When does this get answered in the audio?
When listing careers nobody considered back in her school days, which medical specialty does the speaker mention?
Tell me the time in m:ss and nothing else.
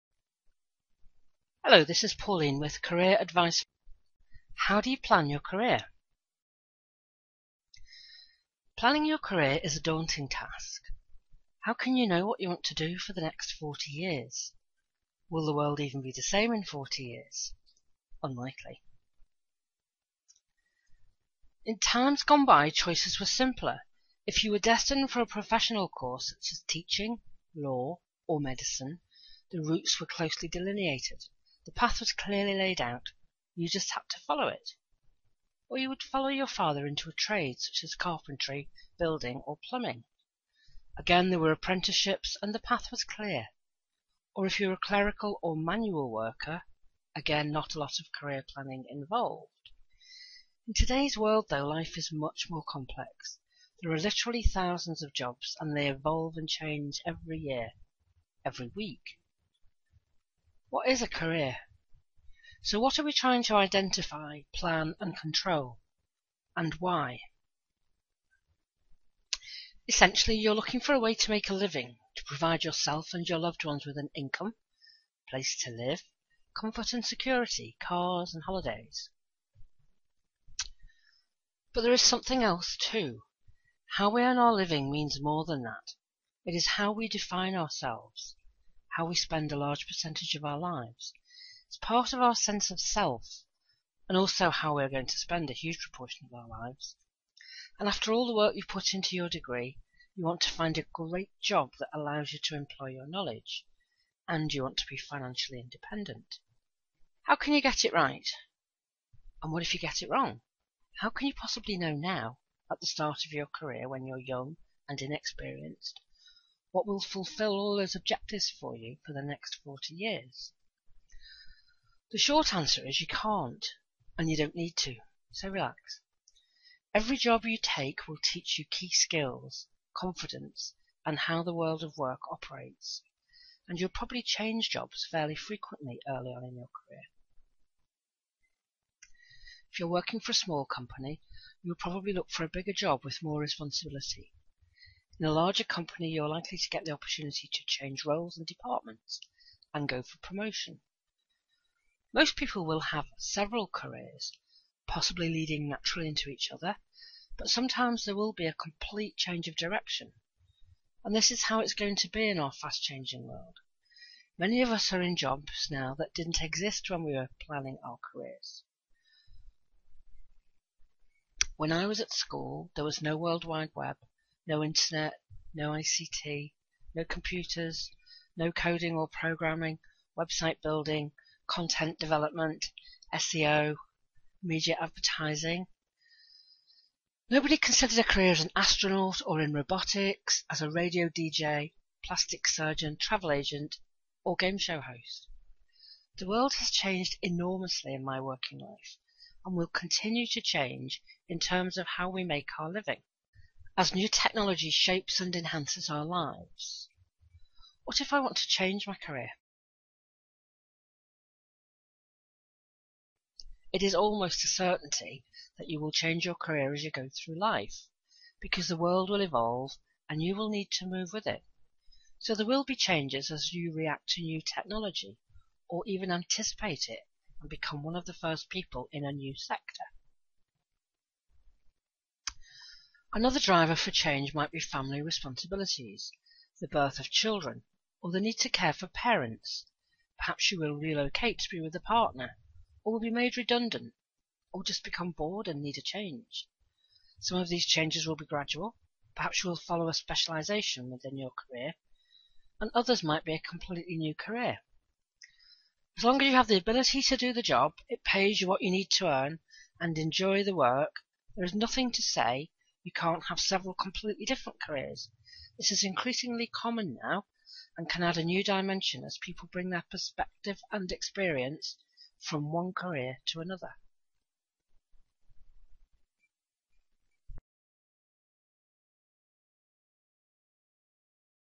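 3:12.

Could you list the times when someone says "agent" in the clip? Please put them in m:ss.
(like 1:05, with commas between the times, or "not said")
3:13.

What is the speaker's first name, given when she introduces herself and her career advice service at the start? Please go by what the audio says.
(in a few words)
Pauline.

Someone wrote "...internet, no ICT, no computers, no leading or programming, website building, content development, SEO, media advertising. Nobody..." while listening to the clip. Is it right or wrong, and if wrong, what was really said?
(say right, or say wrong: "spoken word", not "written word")
wrong: "coding", not "leading".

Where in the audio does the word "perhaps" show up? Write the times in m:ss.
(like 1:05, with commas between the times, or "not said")
4:00, 4:09.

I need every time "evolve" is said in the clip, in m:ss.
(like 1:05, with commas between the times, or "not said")
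0:55, 3:39.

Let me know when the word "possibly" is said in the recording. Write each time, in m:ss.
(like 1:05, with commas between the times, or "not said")
1:51, 2:34.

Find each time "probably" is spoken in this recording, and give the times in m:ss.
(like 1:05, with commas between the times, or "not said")
2:13, 2:21.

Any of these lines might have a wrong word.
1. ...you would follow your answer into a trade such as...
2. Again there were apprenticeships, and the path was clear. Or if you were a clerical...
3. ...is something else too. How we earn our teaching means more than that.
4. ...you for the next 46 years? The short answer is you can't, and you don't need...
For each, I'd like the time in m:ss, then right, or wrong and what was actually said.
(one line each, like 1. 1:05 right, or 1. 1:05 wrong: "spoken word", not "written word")
1. 0:35 wrong: "father", not "answer"
2. 0:40 right
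3. 1:21 wrong: "living", not "teaching"
4. 1:58 wrong: "40", not "46".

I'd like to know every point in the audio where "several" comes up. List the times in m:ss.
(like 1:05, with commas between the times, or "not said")
2:33, 4:23.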